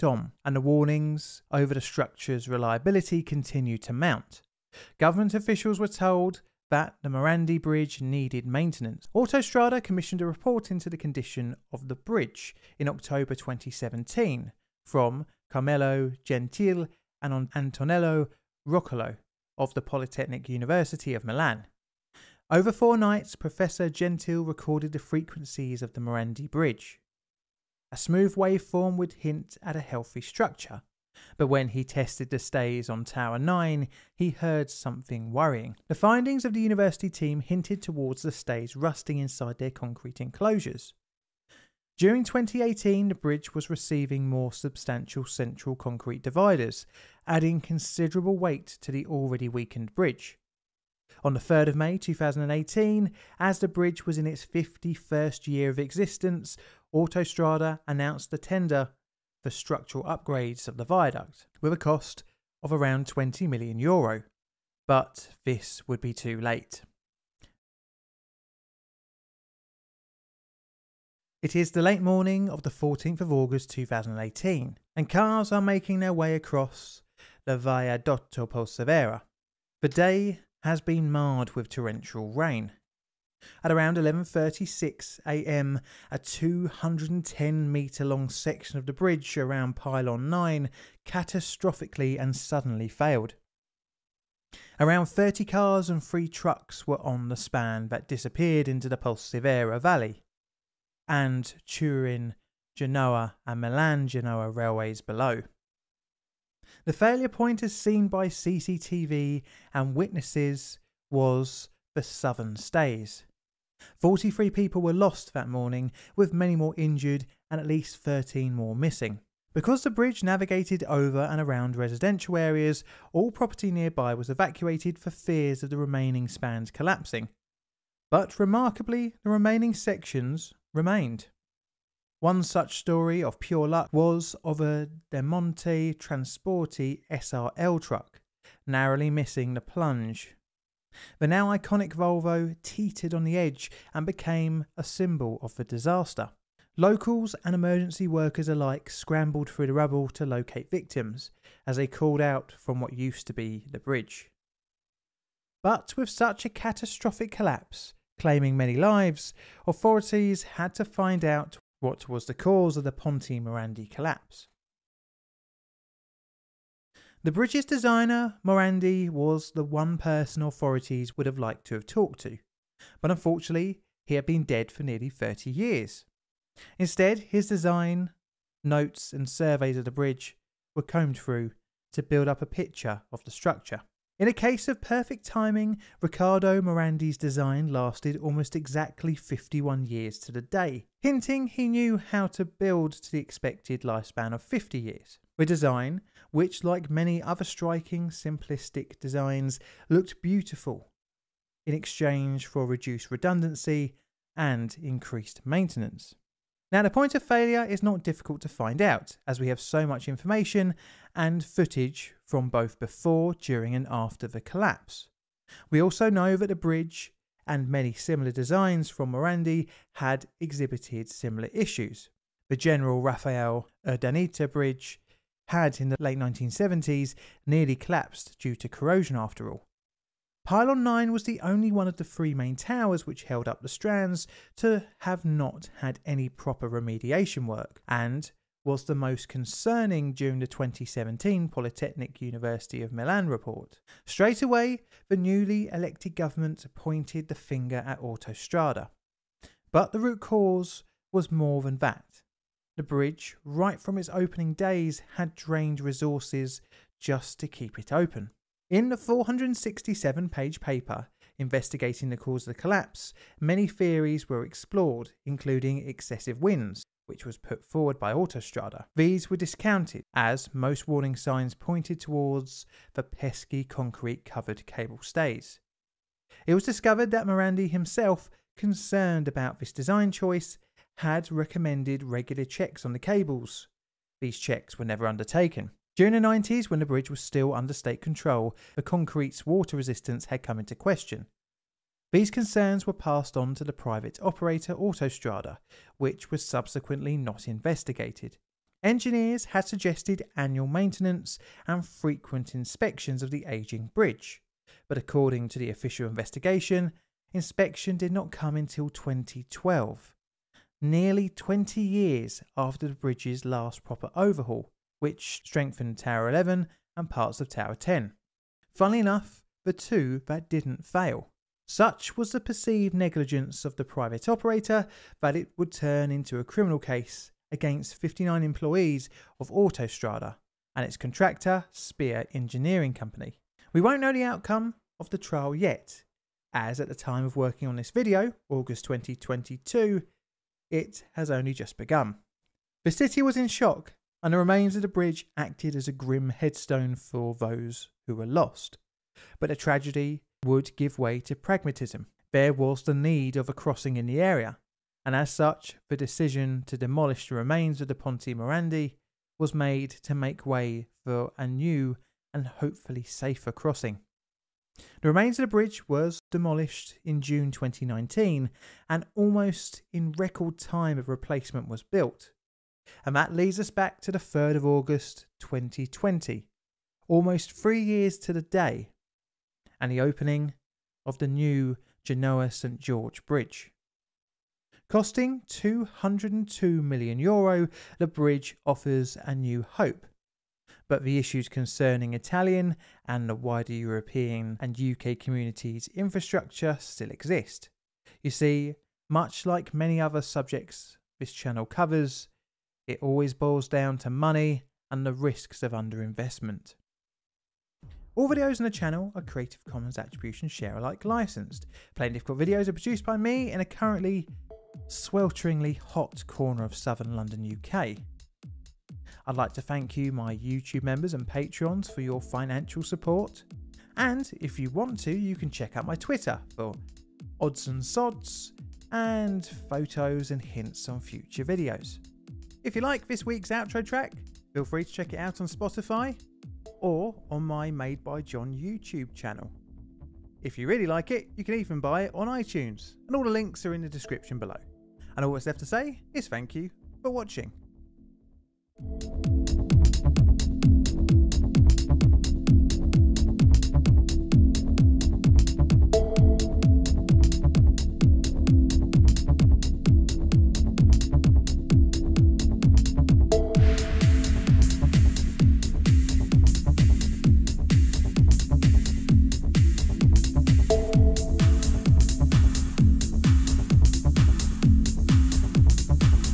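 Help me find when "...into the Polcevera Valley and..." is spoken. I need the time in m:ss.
1:38.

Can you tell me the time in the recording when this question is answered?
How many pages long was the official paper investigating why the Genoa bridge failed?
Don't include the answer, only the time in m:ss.
4:18.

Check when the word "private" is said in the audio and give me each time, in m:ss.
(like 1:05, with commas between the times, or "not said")
4:53, 5:23.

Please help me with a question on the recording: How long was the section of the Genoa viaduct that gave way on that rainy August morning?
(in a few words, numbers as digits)
210 meters.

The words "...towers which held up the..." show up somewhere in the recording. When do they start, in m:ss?
3:52.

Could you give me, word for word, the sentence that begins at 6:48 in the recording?
All videos on the channel are Creative Commons Attribution Share Alike licensed.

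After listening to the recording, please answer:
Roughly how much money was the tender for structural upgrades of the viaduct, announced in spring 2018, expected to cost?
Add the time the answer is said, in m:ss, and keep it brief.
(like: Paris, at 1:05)
20 million euro, at 1:03.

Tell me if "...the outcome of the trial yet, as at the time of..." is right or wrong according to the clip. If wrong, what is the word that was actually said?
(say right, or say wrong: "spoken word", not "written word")
right.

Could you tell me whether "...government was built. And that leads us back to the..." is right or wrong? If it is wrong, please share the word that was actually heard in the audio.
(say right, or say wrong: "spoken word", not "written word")
wrong: "replacement", not "government".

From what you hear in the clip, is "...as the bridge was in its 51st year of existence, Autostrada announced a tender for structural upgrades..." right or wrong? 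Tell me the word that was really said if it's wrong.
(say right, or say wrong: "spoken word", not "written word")
right.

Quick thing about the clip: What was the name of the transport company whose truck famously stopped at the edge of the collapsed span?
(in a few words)
Demonte Transporti SRL.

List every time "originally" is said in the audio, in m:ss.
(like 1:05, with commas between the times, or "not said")
not said.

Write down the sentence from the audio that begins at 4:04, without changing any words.
Straight away, the newly elected government pointed the finger at Autostrada.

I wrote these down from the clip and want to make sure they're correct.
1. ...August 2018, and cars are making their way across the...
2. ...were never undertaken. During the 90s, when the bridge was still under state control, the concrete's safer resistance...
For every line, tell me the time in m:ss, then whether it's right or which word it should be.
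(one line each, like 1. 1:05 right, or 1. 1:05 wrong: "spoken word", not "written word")
1. 1:13 right
2. 4:44 wrong: "water", not "safer".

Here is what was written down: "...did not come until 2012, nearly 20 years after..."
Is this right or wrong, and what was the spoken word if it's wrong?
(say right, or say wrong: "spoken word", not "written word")
right.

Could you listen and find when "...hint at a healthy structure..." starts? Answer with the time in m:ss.
0:29.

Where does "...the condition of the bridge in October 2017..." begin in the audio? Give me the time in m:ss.
0:10.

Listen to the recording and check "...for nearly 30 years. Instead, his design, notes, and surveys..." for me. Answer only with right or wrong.
right.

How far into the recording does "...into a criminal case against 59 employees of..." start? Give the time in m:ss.
5:26.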